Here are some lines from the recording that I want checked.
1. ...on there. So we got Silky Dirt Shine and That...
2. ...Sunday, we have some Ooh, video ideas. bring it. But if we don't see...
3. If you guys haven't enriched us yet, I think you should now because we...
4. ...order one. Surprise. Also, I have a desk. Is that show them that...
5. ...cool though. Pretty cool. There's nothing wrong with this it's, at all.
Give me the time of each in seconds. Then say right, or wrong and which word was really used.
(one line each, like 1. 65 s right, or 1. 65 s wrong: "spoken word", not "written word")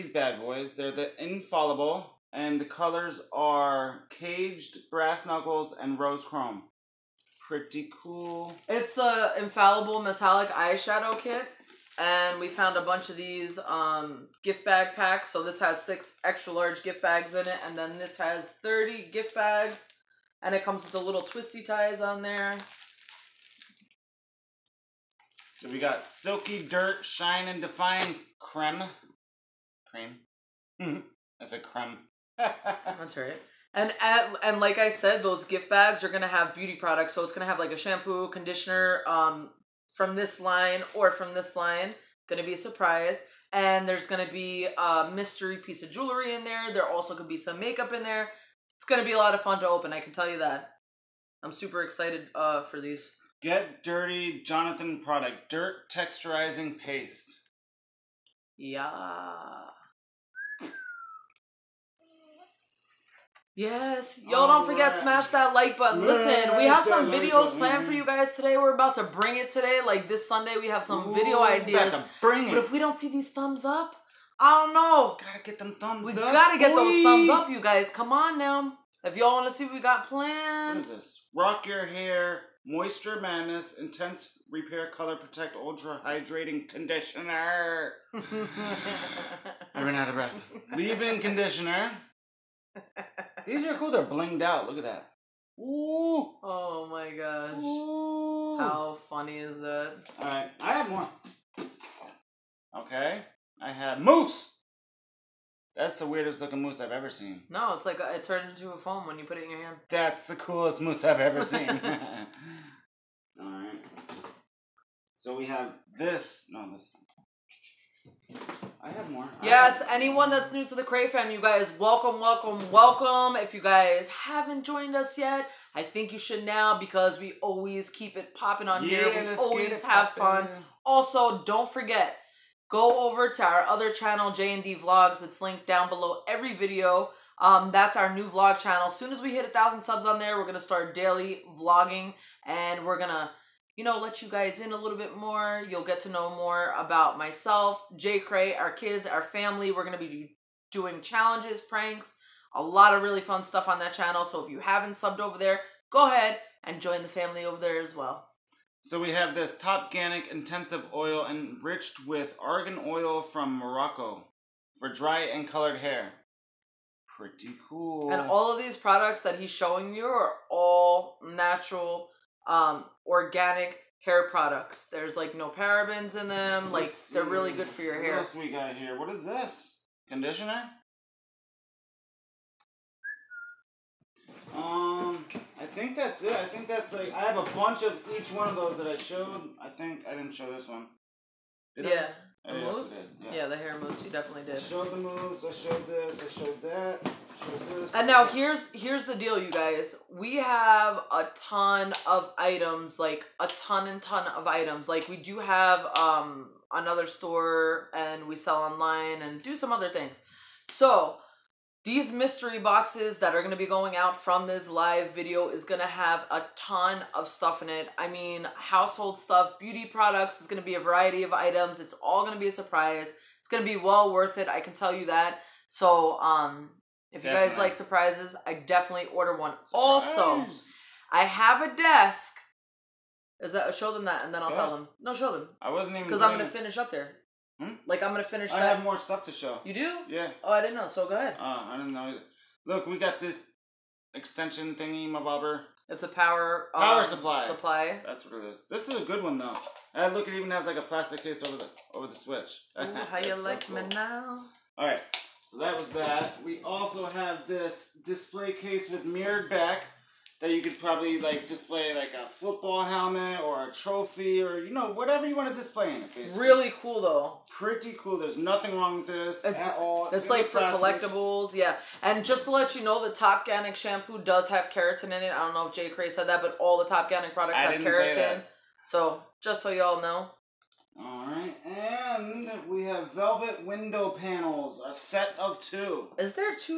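1. 21 s wrong: "Define", not "That"
2. 70 s right
3. 123 s wrong: "joined", not "enriched"
4. 229 s right
5. 266 s right.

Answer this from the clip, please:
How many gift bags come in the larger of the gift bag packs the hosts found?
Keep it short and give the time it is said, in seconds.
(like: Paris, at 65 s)
30, at 18 s.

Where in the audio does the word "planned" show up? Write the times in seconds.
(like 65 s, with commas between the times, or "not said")
67 s, 80 s.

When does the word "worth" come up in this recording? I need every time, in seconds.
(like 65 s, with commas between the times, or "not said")
224 s.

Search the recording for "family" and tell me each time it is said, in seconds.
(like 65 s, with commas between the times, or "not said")
149 s, 157 s.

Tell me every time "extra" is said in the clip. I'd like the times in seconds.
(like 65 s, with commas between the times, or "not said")
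16 s.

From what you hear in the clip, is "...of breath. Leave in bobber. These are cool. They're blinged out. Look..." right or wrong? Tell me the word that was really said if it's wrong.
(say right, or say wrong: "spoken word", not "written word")
wrong: "conditioner", not "bobber".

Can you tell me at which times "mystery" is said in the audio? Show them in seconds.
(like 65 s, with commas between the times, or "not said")
45 s, 212 s.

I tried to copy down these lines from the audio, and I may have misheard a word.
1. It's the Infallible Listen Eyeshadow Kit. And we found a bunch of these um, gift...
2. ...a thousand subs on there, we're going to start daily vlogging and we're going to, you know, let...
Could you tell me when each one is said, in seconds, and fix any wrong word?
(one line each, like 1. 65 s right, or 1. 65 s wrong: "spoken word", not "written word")
1. 8 s wrong: "Metallic", not "Listen"
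2. 139 s right.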